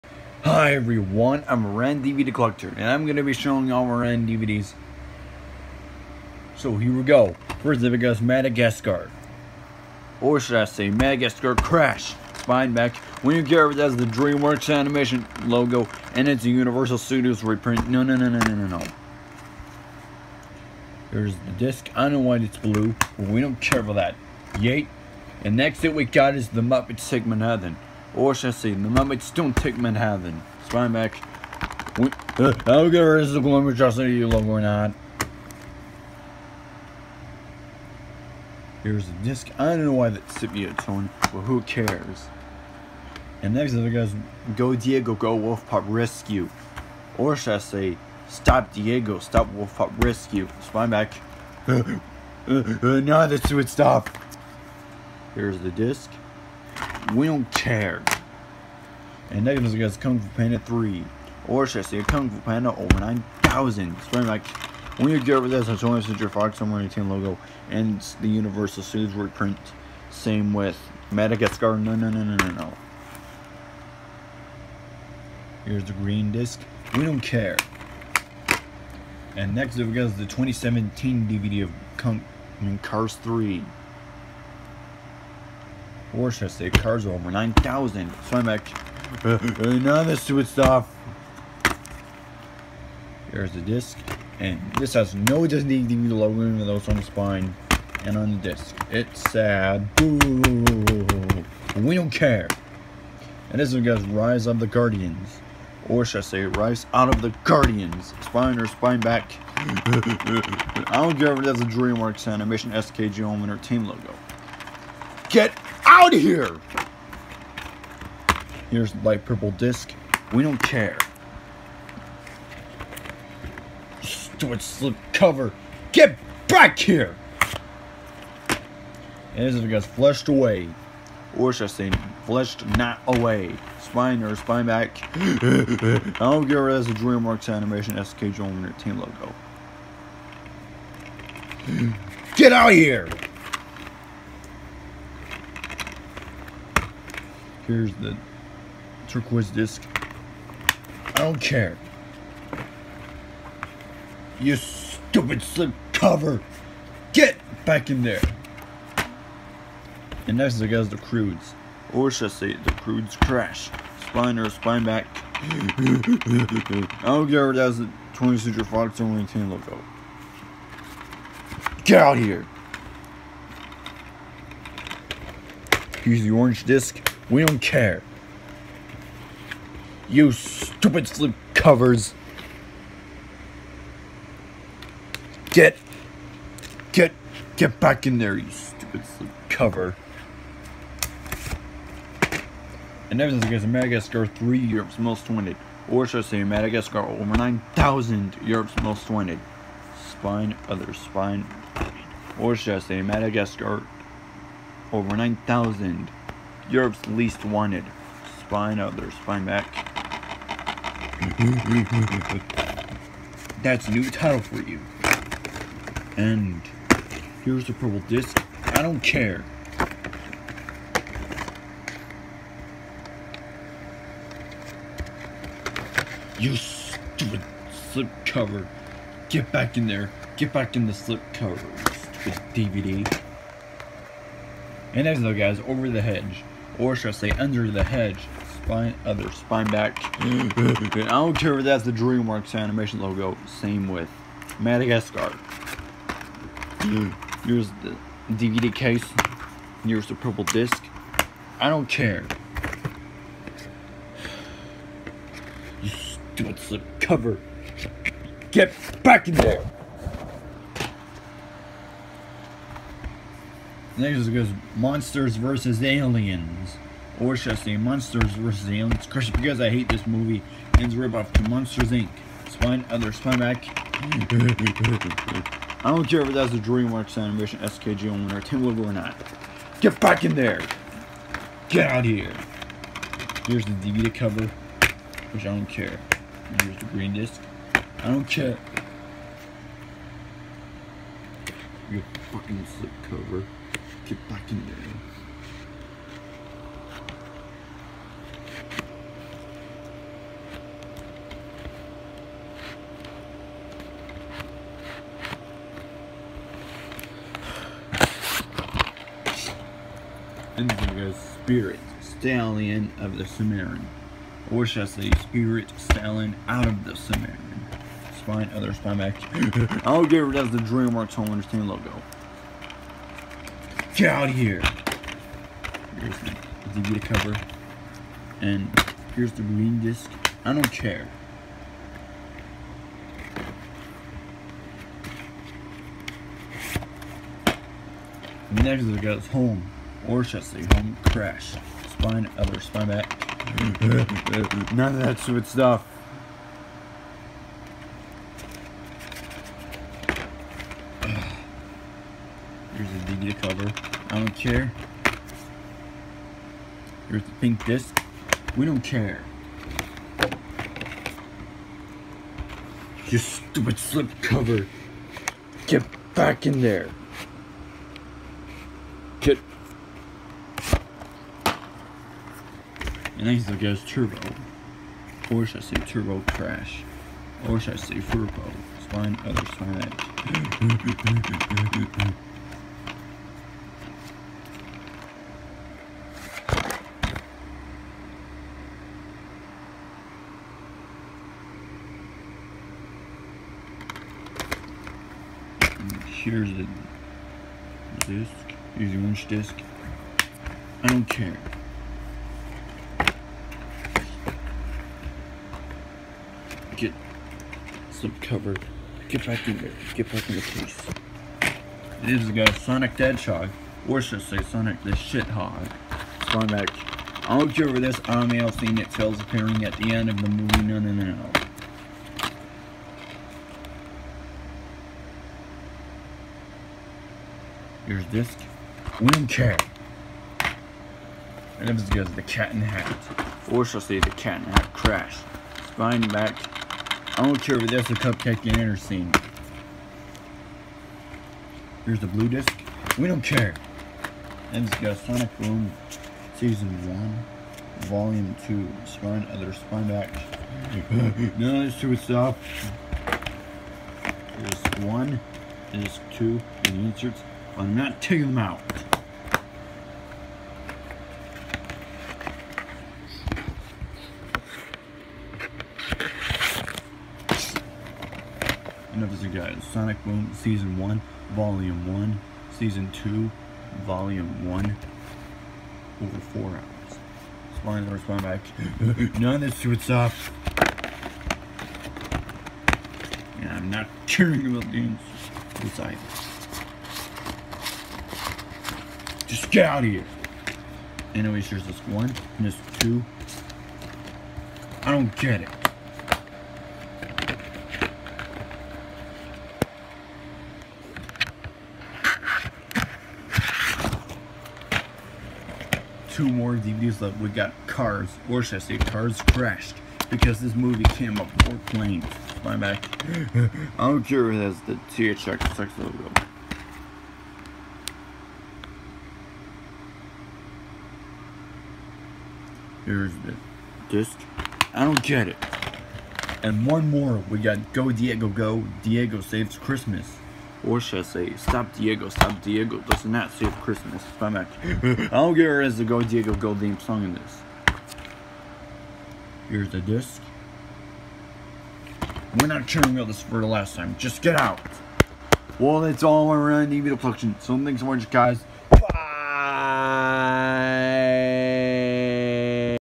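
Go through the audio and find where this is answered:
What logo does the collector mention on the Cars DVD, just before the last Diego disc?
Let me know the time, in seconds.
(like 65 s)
514 s.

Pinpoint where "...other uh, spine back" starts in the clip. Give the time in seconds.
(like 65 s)
449 s.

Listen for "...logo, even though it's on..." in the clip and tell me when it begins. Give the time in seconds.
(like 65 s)
96 s.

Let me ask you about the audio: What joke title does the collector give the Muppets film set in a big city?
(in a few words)
The Muppets Don't Take Manhattan.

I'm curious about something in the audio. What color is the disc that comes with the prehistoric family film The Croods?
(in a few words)
Orange.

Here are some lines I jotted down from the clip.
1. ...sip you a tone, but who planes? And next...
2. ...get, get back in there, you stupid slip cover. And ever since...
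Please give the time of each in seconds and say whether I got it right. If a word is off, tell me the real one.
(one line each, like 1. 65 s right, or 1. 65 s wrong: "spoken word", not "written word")
1. 40 s wrong: "cares", not "planes"
2. 186 s right.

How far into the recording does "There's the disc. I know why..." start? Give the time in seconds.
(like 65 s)
21 s.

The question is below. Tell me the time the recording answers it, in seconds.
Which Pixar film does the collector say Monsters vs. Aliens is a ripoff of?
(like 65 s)
271 s.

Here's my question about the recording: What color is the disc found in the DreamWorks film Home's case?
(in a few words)
Pink.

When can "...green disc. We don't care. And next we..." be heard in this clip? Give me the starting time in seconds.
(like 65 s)
75 s.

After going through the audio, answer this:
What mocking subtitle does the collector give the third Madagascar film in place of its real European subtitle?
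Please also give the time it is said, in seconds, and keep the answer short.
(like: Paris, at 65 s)
Europe's least wanted, at 206 s.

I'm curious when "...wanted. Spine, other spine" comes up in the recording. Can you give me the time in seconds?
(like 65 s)
199 s.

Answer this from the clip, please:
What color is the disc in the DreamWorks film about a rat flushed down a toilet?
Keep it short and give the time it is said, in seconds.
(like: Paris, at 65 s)
Turquoise, at 149 s.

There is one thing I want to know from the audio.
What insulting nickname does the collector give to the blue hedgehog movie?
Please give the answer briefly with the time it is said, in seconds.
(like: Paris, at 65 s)
Sonic the Shithog, at 414 s.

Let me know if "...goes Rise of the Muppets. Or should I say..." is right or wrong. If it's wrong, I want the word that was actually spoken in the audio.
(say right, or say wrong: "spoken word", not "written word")
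wrong: "Guardians", not "Muppets".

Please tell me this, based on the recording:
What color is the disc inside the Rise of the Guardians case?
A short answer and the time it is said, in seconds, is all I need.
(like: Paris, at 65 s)
Light purple, at 119 s.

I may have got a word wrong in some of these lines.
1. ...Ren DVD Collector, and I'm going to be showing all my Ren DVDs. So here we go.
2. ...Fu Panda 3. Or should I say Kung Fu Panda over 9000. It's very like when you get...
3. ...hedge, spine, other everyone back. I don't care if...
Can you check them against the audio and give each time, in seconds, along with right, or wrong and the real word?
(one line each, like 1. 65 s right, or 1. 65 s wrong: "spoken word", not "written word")
1. 1 s right
2. 60 s right
3. 237 s wrong: "spine", not "everyone".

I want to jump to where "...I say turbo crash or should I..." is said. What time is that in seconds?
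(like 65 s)
375 s.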